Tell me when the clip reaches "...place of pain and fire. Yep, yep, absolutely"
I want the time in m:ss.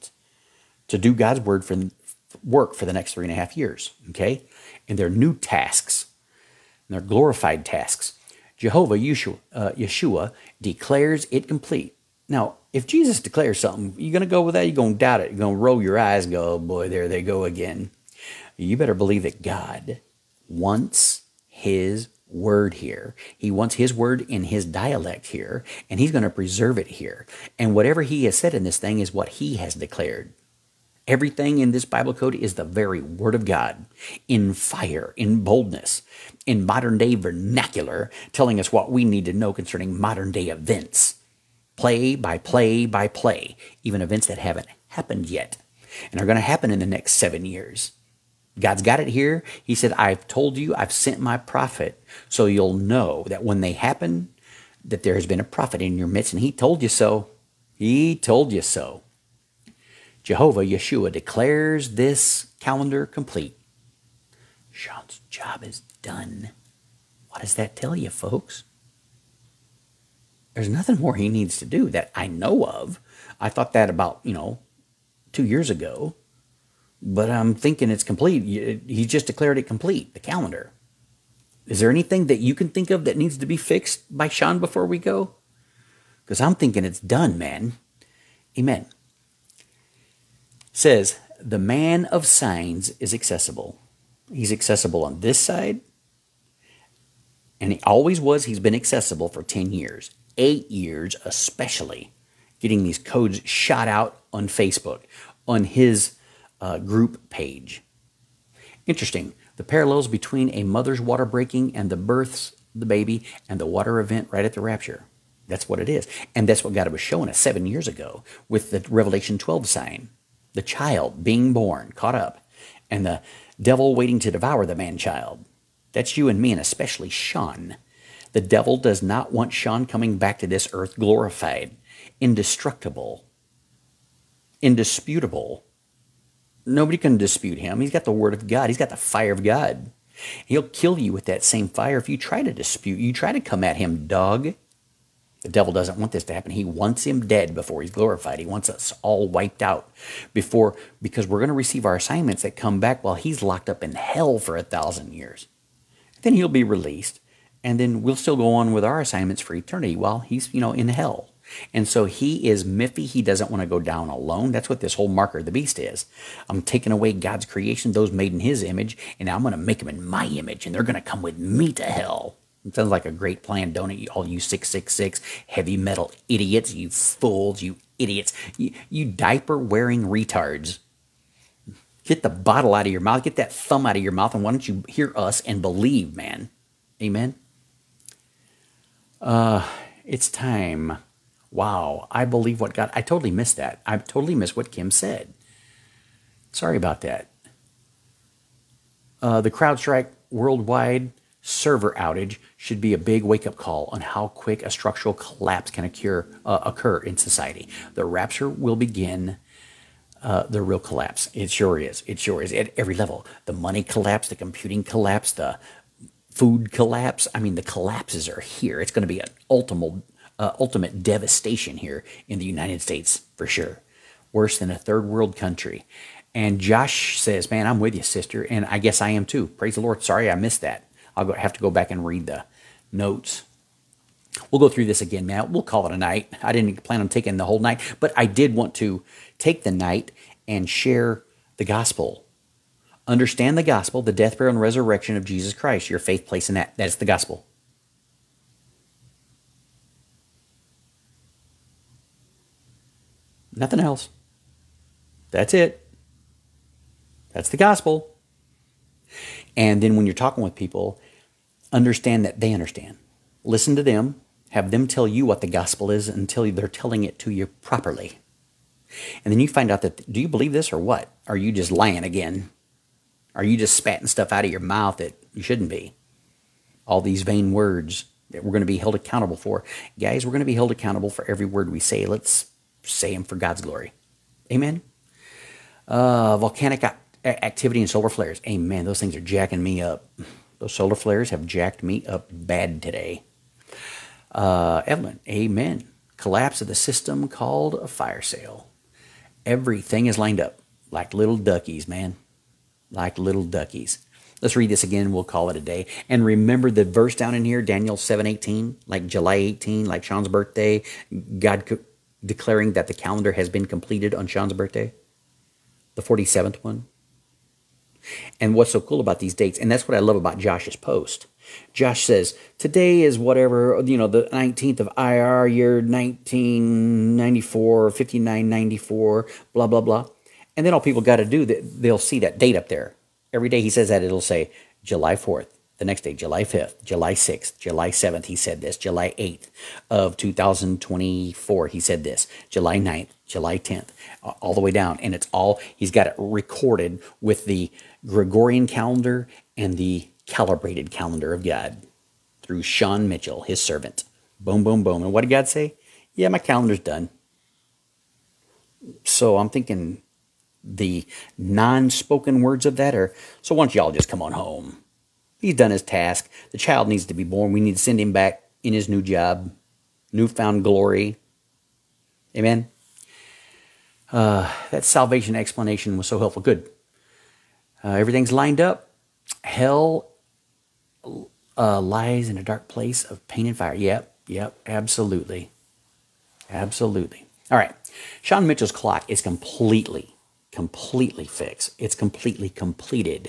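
6:22.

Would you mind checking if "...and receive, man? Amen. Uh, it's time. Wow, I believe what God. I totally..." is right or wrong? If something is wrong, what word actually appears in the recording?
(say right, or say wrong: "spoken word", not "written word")
wrong: "believe", not "receive".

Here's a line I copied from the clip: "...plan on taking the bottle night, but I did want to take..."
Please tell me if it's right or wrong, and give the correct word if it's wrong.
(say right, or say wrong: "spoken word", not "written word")
wrong: "whole", not "bottle".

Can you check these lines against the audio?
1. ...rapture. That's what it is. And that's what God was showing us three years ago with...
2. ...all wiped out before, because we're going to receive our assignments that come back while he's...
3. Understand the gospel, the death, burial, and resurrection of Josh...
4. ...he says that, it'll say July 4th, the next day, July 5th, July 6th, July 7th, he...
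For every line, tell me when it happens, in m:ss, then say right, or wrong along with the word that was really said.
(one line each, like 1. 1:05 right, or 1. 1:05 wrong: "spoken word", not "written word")
1. 1:54 wrong: "seven", not "three"
2. 2:29 right
3. 4:03 wrong: "Jesus", not "Josh"
4. 5:33 right.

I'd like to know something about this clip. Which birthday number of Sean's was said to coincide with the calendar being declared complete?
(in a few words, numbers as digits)
47th.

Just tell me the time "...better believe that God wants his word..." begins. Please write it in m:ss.
0:18.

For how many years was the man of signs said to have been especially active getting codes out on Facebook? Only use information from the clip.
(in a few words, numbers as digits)
8.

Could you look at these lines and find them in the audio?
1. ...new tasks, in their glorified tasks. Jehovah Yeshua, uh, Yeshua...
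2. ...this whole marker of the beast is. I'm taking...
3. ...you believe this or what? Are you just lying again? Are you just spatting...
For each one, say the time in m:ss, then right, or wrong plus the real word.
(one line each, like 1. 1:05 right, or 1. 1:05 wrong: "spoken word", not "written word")
1. 0:05 right
2. 2:44 right
3. 4:30 right.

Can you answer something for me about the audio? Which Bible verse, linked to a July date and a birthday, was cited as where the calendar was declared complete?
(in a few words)
Daniel 7:18.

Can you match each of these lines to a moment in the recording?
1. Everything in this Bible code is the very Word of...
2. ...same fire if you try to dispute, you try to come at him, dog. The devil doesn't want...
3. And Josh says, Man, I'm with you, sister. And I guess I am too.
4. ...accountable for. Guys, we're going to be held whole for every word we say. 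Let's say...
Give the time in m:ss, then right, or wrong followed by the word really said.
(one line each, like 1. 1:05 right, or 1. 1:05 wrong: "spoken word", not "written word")
1. 0:31 right
2. 2:21 right
3. 3:46 right
4. 4:38 wrong: "accountable", not "whole".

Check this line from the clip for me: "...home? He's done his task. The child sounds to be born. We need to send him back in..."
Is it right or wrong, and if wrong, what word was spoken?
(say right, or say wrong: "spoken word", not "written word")
wrong: "needs", not "sounds".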